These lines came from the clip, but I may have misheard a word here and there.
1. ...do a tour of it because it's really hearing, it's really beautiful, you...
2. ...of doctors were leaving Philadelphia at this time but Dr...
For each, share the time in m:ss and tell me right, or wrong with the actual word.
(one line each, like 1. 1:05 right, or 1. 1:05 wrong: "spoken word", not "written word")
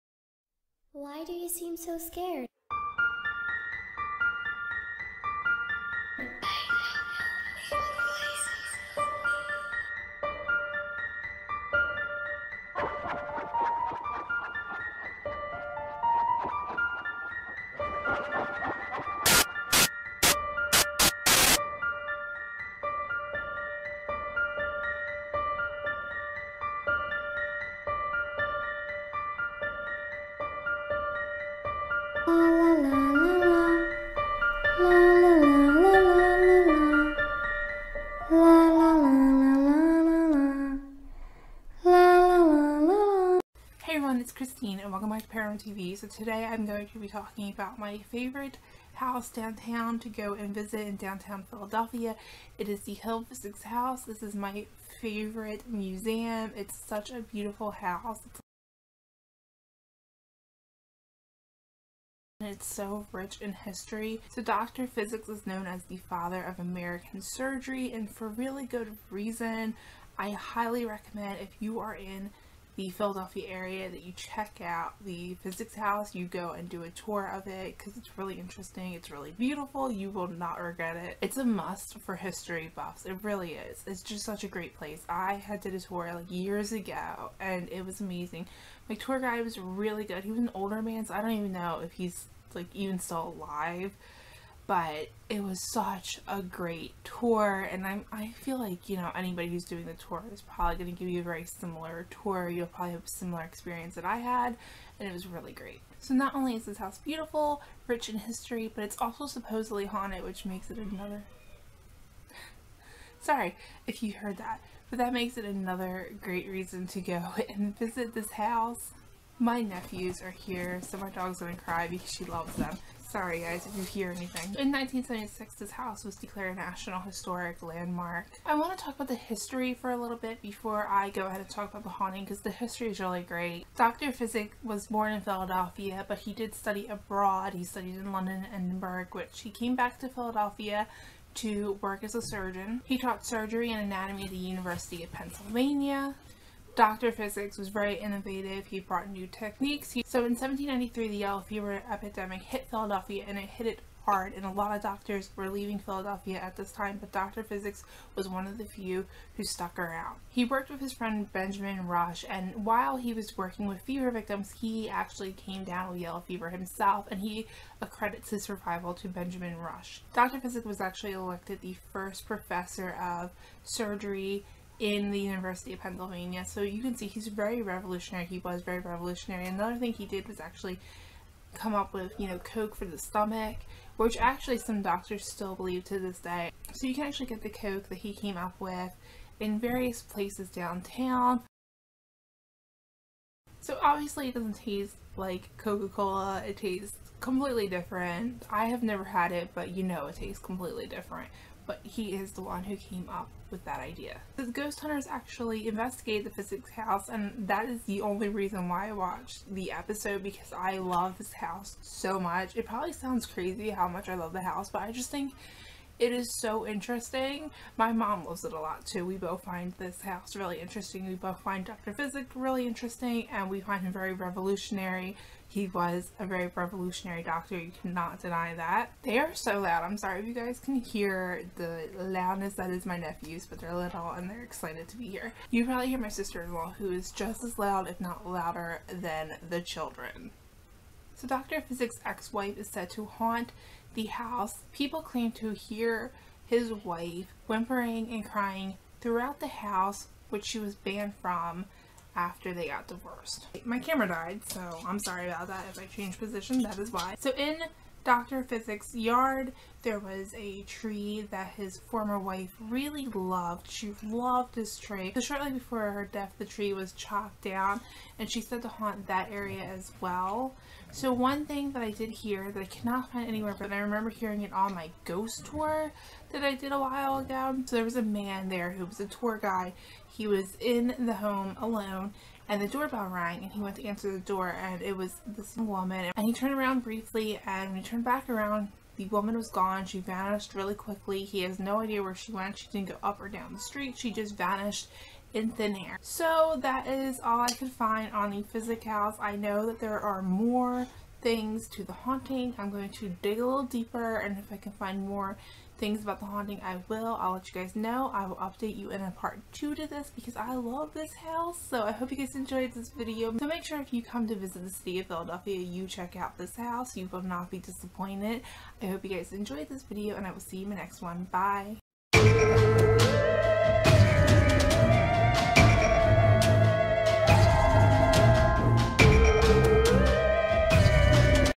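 1. 1:16 wrong: "interesting", not "hearing"
2. 2:34 right.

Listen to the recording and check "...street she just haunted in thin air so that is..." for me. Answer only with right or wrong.
wrong.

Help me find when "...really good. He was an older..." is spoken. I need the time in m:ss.
1:29.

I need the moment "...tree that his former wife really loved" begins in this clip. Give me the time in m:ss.
4:20.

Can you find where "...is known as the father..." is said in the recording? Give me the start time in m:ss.
1:05.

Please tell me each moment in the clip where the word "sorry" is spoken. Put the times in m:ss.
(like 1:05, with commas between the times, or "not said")
1:53, 2:03, 3:49, 4:14.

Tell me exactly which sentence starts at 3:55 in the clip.
You probably hear my sister-in-law who is just as loud, if not louder, than the children.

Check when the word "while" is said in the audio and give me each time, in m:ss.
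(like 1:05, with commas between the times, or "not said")
2:42, 4:36.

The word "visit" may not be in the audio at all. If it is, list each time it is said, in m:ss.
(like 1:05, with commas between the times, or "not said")
0:50, 1:57, 5:14.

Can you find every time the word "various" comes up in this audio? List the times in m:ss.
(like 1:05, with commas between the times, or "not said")
3:09.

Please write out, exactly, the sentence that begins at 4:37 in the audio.
So there was a man there who was a tour guide.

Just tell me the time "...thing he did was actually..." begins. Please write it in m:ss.
2:59.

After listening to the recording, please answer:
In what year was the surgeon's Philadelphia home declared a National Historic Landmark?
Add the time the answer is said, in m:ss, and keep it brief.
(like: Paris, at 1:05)
1976, at 2:04.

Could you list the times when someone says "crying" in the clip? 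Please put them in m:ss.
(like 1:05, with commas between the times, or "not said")
4:08.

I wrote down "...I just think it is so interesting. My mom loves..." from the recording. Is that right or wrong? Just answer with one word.
right.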